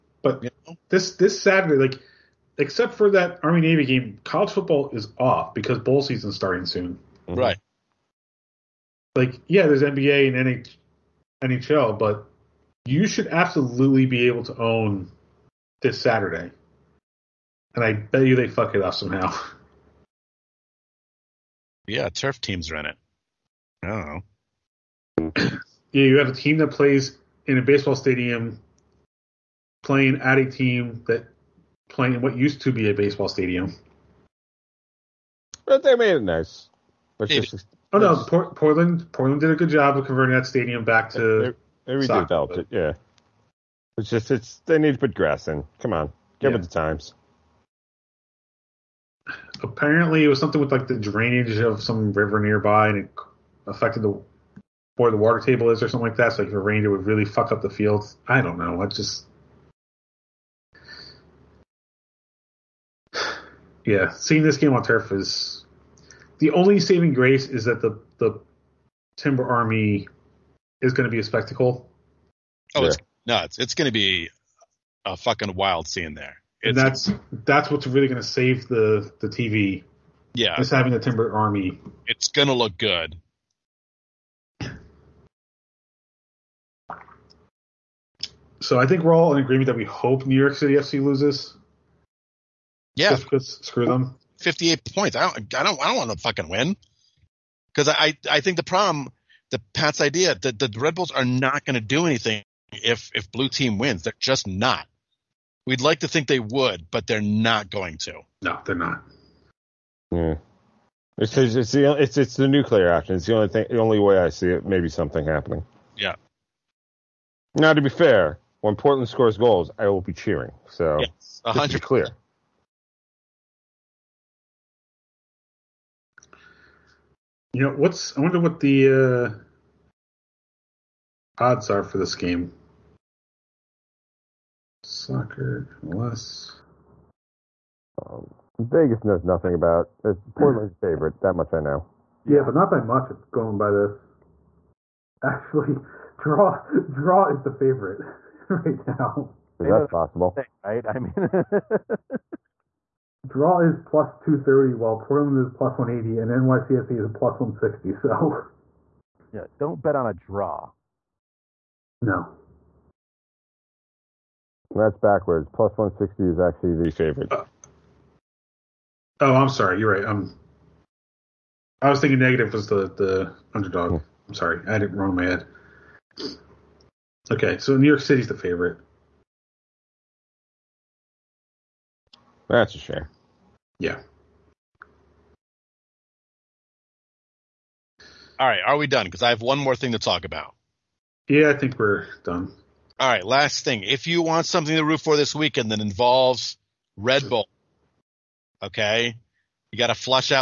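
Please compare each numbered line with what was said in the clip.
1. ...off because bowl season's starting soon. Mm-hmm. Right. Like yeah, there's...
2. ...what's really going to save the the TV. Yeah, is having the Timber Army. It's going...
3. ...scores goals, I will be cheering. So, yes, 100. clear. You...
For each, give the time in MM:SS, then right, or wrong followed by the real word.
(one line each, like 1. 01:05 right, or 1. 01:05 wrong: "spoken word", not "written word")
1. 00:05 right
2. 01:17 right
3. 01:59 right.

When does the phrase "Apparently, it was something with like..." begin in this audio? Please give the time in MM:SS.
00:49.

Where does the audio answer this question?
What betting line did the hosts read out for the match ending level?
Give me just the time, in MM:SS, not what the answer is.
02:33.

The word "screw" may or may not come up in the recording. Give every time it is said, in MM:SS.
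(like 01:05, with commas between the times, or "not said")
01:33.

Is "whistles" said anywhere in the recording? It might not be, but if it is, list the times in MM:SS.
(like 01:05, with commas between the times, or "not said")
not said.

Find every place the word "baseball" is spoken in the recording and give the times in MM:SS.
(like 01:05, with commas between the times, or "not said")
00:27, 00:32.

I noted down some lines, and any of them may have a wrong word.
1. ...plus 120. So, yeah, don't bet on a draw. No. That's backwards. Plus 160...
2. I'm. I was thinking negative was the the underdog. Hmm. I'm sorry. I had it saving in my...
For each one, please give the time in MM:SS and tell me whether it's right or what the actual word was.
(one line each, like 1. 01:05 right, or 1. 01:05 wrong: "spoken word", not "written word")
1. 02:37 wrong: "160", not "120"
2. 02:50 wrong: "wrong", not "saving".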